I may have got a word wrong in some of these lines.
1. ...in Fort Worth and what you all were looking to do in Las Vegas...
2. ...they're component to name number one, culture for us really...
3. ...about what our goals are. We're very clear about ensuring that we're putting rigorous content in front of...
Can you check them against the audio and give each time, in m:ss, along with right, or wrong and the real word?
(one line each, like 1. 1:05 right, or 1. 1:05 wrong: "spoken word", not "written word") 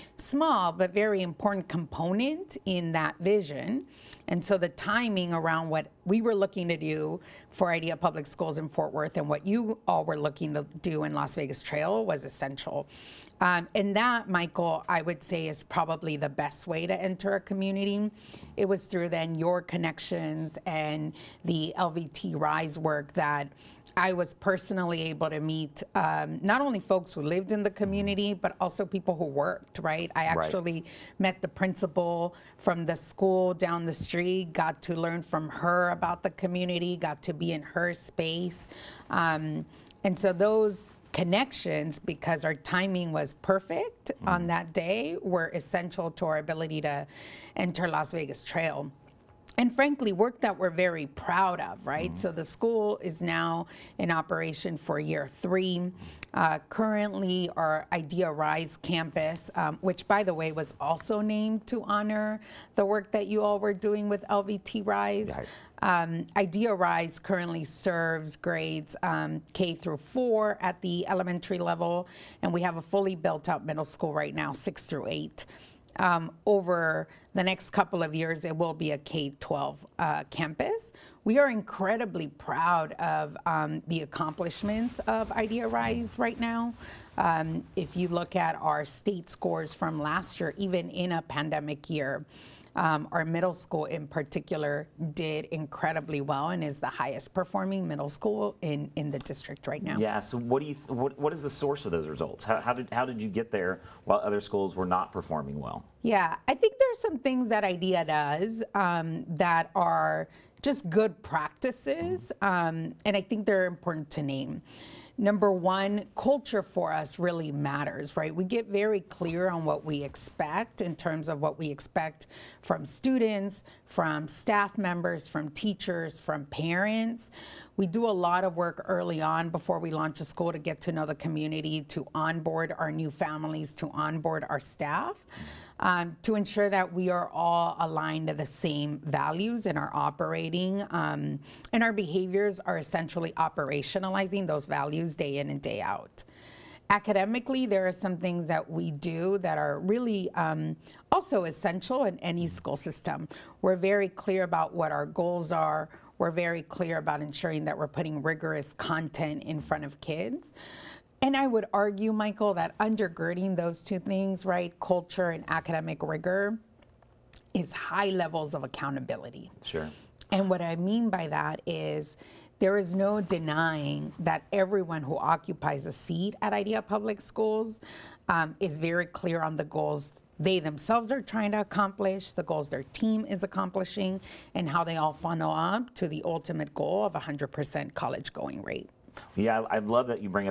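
1. 0:08 right
2. 1:53 wrong: "important", not "component"
3. 2:34 right.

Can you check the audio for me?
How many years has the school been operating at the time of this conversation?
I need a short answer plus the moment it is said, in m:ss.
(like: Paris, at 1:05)
3, at 0:55.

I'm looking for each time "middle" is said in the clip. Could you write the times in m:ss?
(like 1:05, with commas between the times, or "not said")
1:13, 1:33, 1:37.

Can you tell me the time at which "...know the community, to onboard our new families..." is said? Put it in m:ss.
2:10.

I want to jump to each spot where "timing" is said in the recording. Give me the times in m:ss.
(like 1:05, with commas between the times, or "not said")
0:04, 0:42.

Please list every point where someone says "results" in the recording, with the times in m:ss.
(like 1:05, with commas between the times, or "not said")
1:42.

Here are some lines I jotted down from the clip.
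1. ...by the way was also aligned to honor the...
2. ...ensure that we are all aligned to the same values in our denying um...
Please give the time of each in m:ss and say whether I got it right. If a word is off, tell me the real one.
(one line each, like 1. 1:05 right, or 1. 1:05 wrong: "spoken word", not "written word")
1. 1:00 wrong: "named", not "aligned"
2. 2:16 wrong: "operating", not "denying".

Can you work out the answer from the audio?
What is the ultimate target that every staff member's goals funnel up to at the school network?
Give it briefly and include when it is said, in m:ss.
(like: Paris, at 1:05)
100% college going rate, at 3:07.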